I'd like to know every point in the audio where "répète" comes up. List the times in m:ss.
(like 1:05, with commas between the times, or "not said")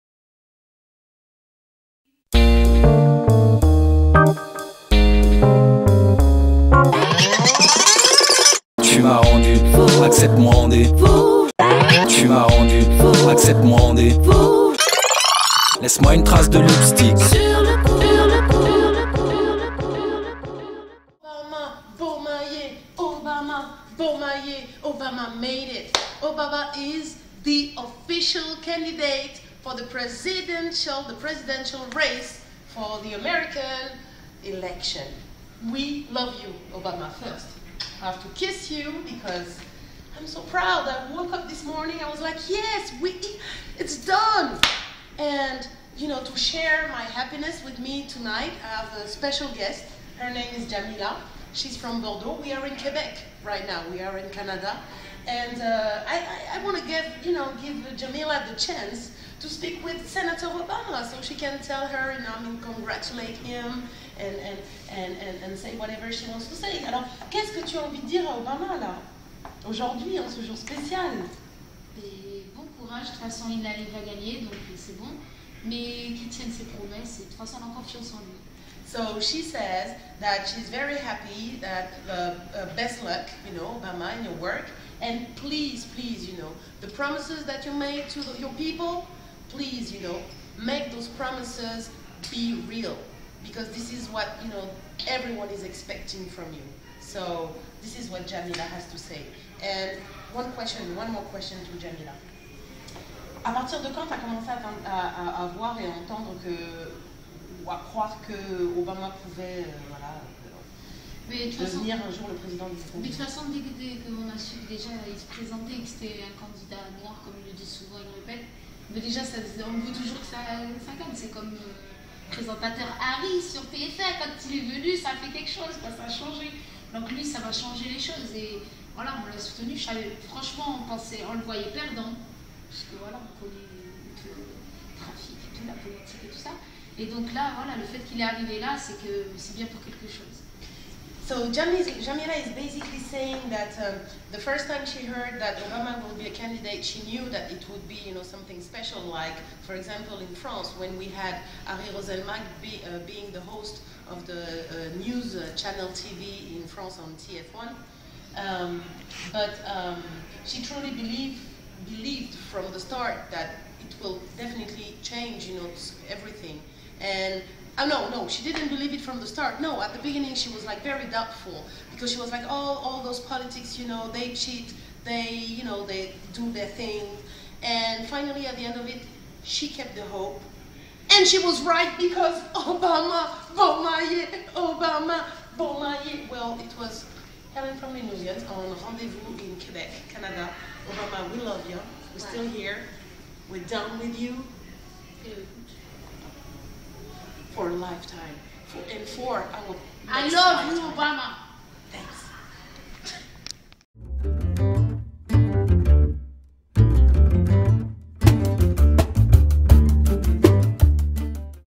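1:58.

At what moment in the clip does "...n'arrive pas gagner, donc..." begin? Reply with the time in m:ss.
1:13.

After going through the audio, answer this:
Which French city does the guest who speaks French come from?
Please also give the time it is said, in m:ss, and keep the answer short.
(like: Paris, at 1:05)
Bordeaux, at 0:51.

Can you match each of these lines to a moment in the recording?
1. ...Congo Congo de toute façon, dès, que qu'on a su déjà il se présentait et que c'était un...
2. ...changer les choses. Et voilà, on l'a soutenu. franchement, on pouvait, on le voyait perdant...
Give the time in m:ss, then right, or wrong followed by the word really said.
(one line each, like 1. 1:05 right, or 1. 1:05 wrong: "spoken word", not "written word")
1. 1:52 wrong: "Mais", not "Congo"
2. 2:07 wrong: "pensait", not "pouvait".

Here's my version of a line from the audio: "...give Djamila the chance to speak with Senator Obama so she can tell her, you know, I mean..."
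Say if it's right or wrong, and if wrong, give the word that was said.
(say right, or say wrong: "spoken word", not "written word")
right.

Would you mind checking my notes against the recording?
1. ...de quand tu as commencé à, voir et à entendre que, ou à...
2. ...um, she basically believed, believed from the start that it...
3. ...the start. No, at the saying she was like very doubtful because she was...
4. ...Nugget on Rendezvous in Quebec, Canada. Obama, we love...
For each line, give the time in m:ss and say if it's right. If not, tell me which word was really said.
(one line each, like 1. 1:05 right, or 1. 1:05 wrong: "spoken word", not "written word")
1. 1:43 right
2. 2:39 wrong: "truly", not "basically"
3. 2:49 wrong: "beginning", not "saying"
4. 3:08 right.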